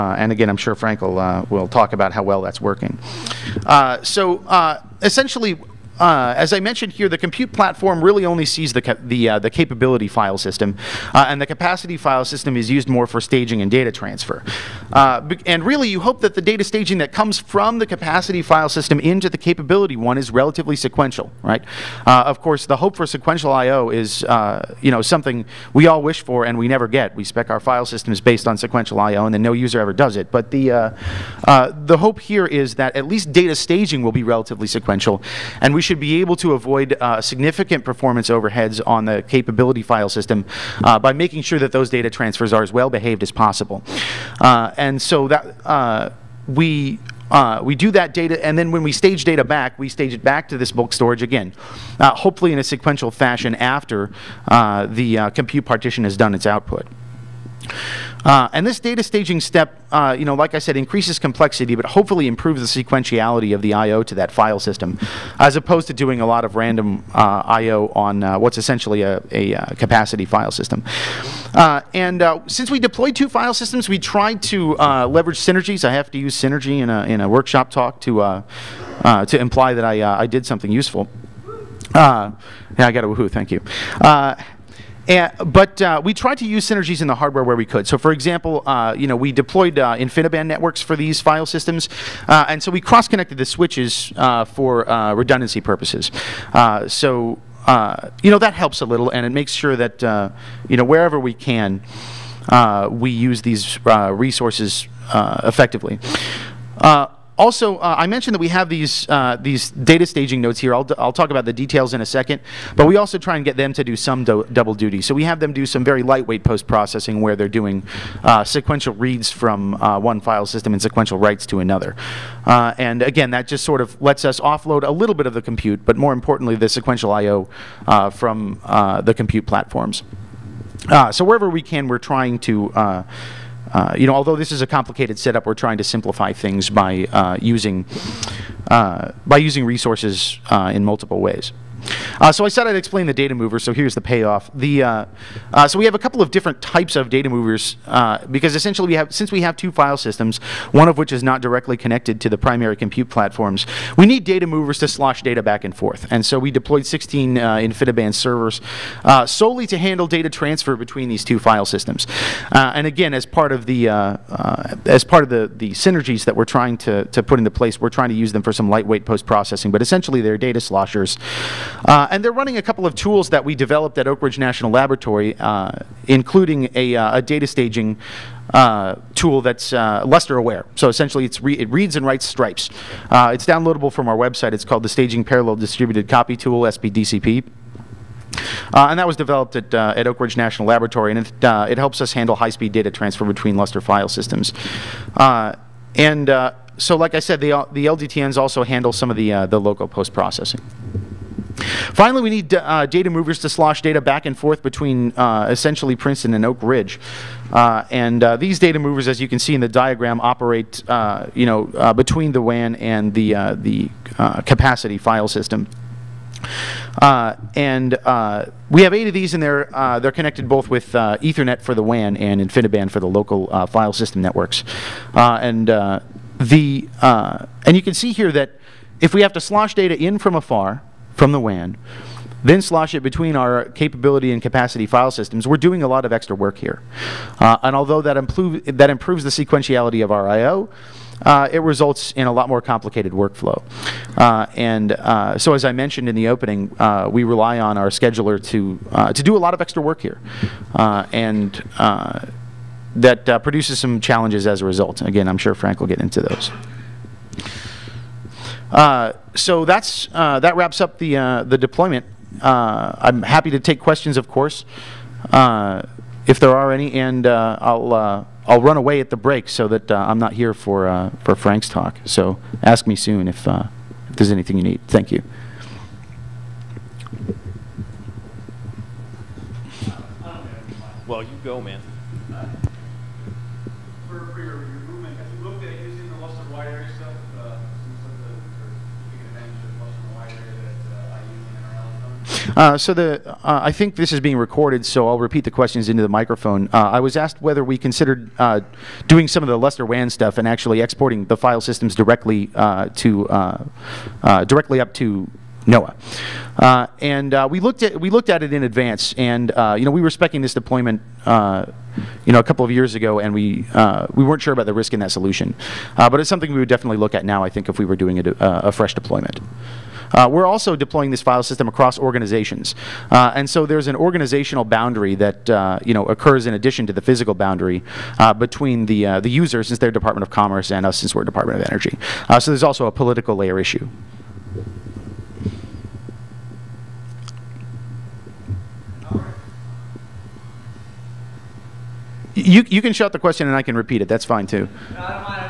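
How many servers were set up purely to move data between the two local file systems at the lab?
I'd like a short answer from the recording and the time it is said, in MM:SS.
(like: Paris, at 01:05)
16, at 02:36.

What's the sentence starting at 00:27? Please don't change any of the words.
We spec our file systems based on sequential I.O., and then no user ever does it.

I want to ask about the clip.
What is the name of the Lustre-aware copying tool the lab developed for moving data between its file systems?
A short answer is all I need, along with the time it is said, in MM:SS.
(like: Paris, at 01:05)
Staging Parallel Distributed Copy Tool, at 03:04.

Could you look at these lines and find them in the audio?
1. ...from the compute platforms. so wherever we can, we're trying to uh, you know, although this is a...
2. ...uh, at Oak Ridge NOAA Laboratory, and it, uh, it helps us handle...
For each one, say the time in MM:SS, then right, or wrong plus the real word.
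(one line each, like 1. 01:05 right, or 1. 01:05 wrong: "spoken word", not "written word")
1. 02:08 right
2. 03:09 wrong: "National", not "NOAA".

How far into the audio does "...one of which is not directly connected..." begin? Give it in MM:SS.
02:30.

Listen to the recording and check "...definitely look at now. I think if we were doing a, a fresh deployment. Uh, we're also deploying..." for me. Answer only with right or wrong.
right.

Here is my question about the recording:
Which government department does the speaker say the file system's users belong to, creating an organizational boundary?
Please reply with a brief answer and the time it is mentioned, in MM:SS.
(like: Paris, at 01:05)
Department of Commerce, at 05:29.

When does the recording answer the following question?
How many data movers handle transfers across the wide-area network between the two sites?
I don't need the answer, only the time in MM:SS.
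03:38.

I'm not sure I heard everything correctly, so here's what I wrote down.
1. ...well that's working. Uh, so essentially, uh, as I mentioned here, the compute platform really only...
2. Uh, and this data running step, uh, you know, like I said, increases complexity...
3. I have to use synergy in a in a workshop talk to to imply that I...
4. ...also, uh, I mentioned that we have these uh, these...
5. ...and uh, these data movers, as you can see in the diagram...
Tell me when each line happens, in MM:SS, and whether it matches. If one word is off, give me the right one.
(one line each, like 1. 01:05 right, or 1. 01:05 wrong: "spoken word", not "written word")
1. 00:02 right
2. 00:58 wrong: "staging", not "running"
3. 01:15 right
4. 01:47 right
5. 03:27 right.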